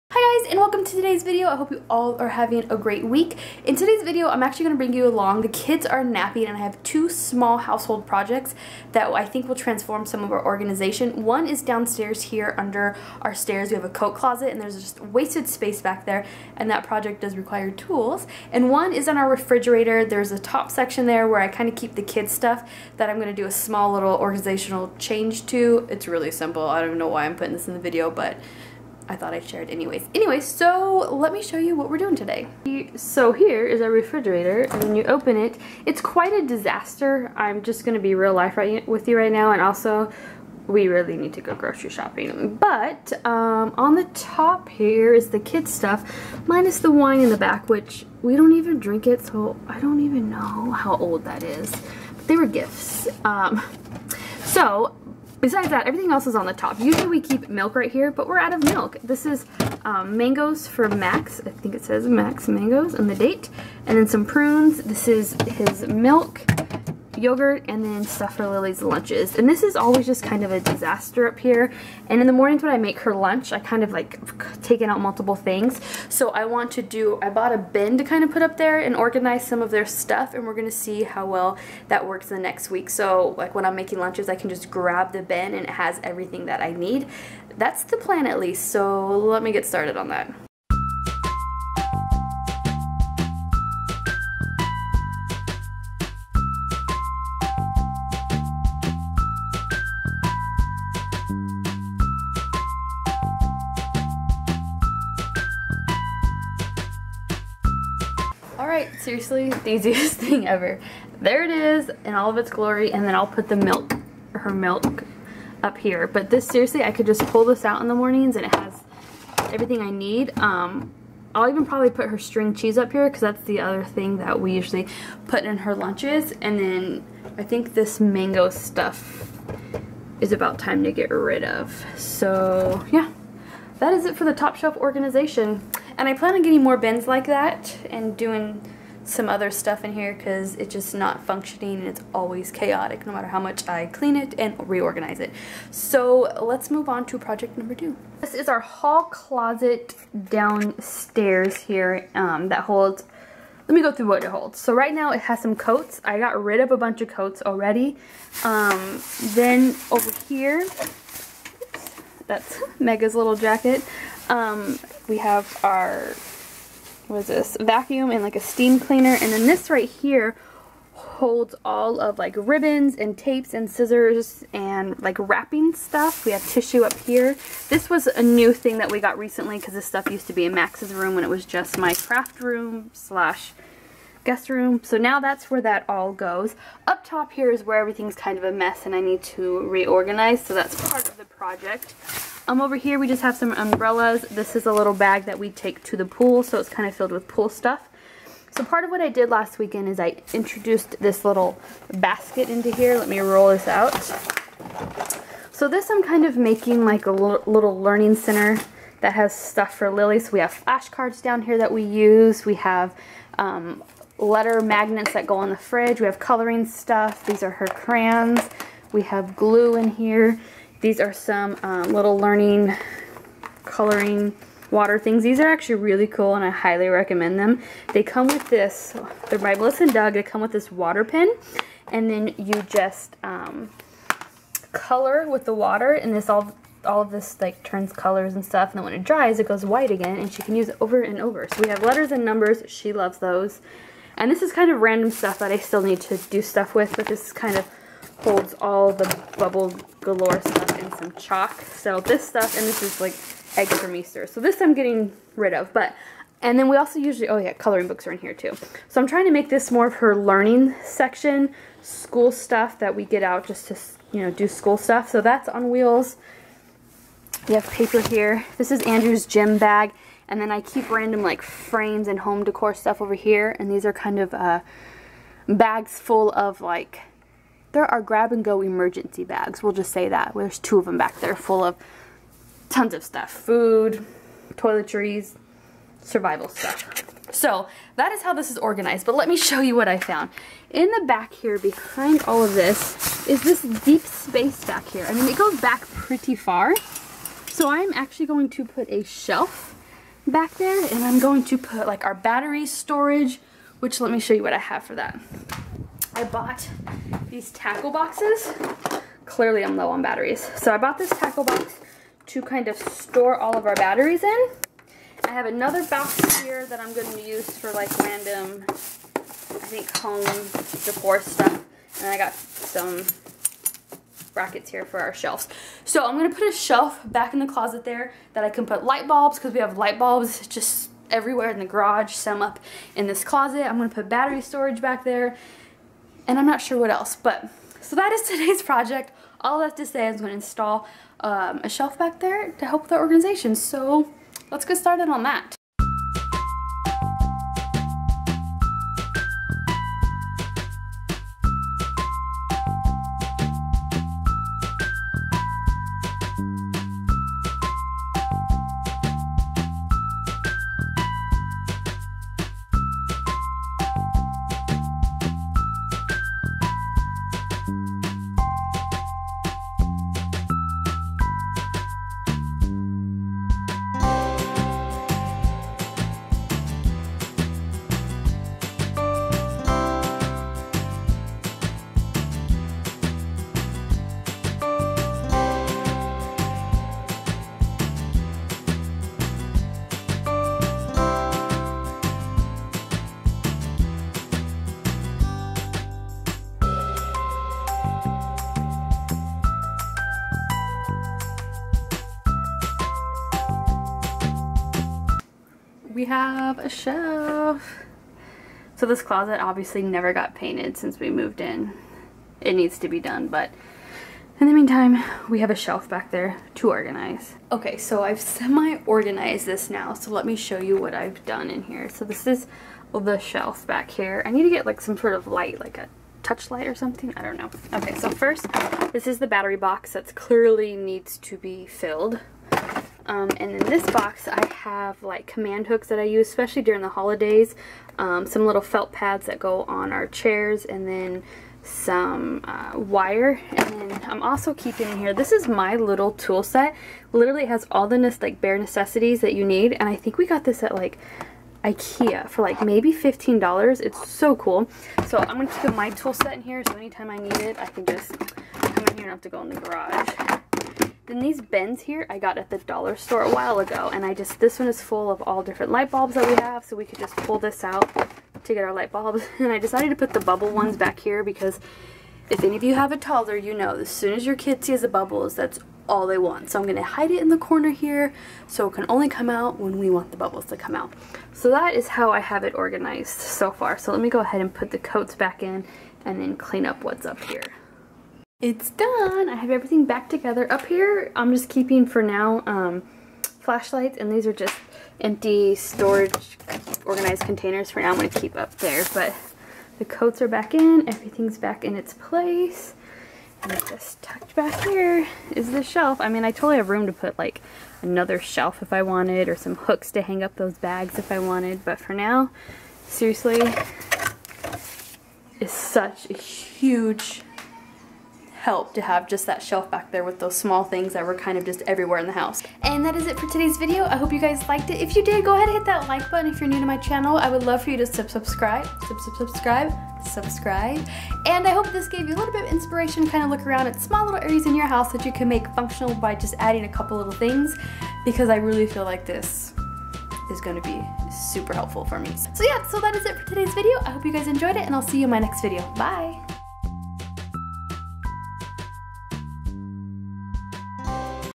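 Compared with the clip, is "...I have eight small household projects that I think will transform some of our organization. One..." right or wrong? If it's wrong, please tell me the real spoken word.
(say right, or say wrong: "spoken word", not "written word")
wrong: "two", not "eight".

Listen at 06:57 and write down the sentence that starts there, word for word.
Okay, so I've semi-organized this now, so let me show you what I've done in here.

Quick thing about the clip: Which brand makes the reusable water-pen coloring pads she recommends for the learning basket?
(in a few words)
Melissa and Doug.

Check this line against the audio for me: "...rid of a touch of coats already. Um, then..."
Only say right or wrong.
wrong.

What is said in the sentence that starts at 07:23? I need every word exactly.
And I'm also keeping in here, this is my little tool set.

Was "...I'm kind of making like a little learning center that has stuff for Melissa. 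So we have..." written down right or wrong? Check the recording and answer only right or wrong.
wrong.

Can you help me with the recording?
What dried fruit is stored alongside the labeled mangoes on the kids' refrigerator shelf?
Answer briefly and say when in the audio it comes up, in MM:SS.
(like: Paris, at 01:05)
prunes, at 01:04.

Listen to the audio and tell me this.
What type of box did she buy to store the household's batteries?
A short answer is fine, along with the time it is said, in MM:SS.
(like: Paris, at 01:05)
tackle box, at 05:07.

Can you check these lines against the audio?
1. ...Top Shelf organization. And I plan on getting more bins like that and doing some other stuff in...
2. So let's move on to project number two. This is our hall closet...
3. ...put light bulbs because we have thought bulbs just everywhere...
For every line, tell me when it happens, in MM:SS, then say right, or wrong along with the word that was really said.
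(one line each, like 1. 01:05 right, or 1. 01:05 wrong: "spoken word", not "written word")
1. 02:14 right
2. 02:25 right
3. 05:28 wrong: "light", not "thought".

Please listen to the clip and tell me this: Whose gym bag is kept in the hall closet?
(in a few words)
Andrew's.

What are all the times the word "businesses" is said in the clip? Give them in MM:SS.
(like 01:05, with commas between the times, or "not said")
not said.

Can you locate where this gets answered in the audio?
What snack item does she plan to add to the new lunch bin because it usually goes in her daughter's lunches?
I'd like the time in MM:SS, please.
02:02.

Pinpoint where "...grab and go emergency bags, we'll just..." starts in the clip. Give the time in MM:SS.
04:38.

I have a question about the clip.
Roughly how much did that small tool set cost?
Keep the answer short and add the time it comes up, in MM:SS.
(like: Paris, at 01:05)
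$15, at 07:32.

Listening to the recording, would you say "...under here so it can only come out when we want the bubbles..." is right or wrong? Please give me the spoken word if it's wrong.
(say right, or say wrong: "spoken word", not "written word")
wrong: "corner", not "under".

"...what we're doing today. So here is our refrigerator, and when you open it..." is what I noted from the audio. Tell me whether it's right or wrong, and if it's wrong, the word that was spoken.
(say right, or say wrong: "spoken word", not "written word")
right.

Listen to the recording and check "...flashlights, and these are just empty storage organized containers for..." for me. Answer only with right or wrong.
right.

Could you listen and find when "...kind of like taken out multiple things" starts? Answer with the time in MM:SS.
01:13.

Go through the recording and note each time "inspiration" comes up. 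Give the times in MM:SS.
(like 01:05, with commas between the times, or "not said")
08:52.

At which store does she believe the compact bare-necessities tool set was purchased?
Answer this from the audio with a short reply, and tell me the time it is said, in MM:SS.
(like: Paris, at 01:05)
Ikea, at 07:31.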